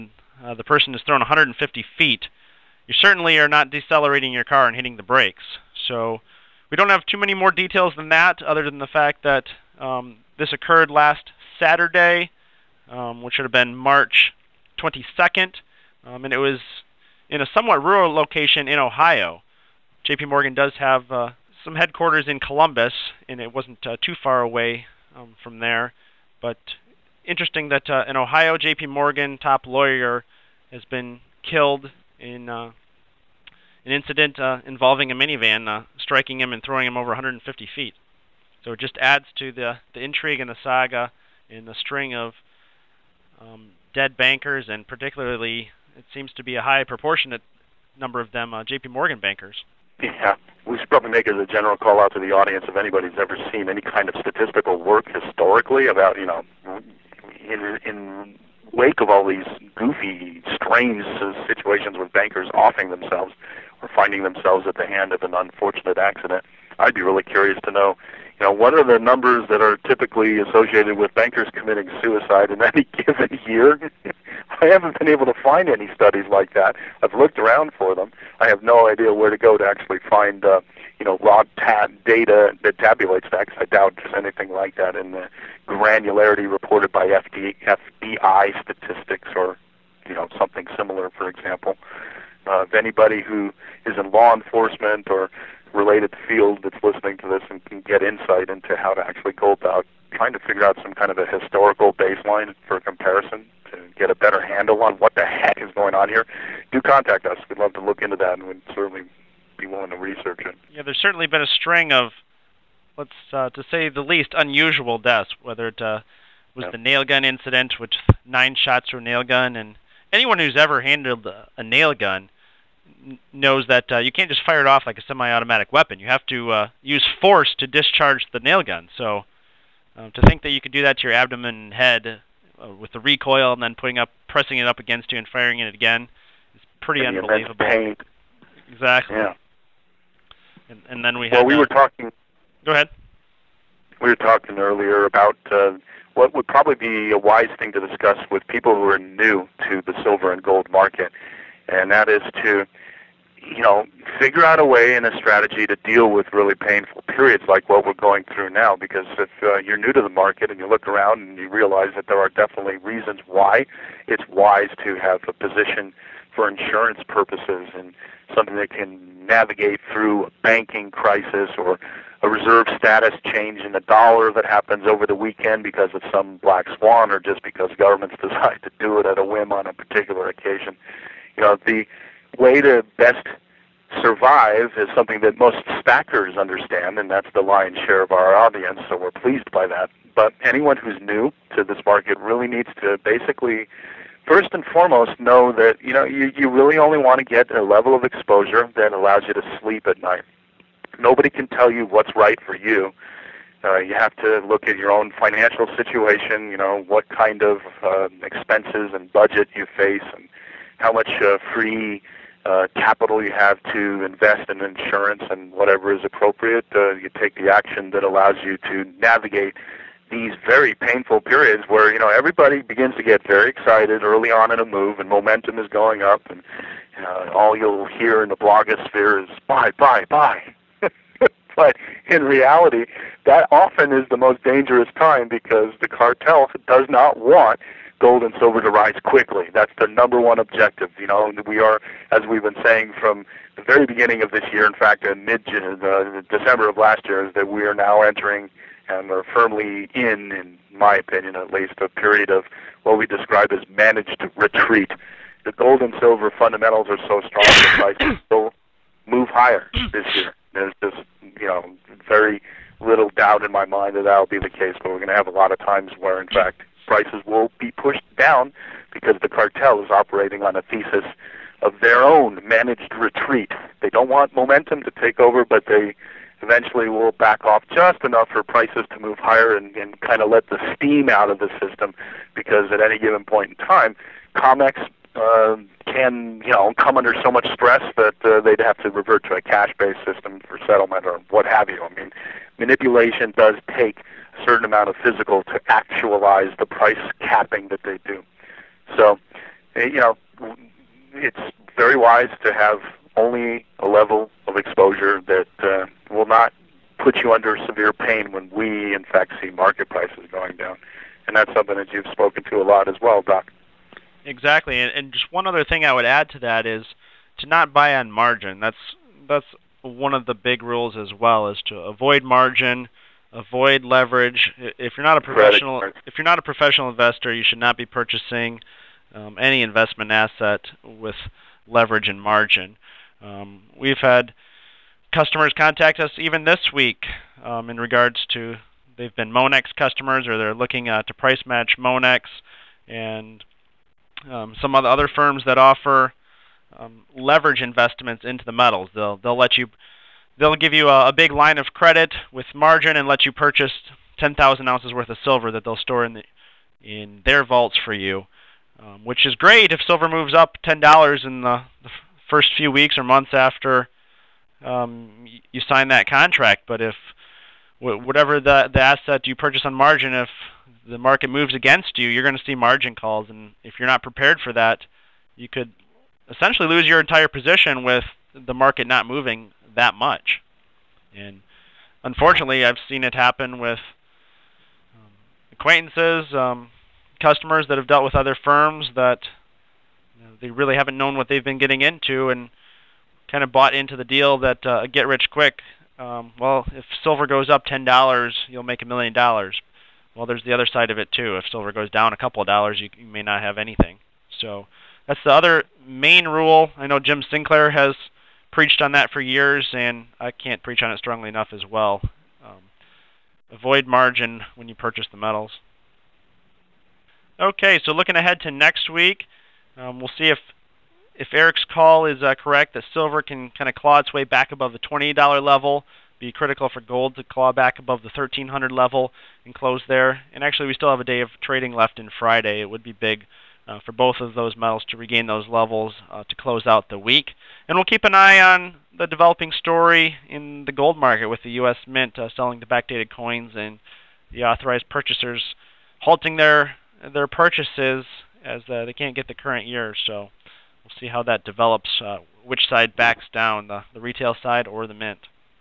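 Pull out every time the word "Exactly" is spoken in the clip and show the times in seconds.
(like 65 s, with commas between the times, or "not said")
138 s, 314 s.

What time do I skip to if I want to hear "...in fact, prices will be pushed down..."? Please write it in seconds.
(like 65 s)
266 s.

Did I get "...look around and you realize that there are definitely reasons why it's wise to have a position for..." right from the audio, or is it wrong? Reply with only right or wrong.
right.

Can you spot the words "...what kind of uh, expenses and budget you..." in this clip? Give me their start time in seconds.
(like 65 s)
206 s.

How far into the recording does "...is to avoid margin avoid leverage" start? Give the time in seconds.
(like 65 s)
321 s.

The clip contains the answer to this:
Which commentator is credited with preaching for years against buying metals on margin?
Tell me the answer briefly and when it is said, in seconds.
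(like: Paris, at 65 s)
Jim Sinclair, at 406 s.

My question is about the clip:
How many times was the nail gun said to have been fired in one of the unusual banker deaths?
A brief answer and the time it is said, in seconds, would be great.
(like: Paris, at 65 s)
9, at 118 s.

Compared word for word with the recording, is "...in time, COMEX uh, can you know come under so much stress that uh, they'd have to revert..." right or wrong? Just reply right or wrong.
right.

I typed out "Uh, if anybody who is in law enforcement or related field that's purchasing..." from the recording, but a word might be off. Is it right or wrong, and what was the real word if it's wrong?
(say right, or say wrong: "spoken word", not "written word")
wrong: "listening", not "purchasing".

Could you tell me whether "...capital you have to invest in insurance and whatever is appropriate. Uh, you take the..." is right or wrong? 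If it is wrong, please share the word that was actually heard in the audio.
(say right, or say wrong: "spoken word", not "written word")
right.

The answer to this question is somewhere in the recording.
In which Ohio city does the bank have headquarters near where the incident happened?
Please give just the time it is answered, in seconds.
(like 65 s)
22 s.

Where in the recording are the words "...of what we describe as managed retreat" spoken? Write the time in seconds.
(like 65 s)
252 s.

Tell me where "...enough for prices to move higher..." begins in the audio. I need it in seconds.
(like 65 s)
278 s.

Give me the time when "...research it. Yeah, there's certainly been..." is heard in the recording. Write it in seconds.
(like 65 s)
109 s.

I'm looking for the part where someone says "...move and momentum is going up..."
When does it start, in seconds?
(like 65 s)
224 s.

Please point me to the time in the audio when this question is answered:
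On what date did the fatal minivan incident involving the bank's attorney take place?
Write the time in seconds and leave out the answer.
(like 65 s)
13 s.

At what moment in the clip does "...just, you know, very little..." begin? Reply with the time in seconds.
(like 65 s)
260 s.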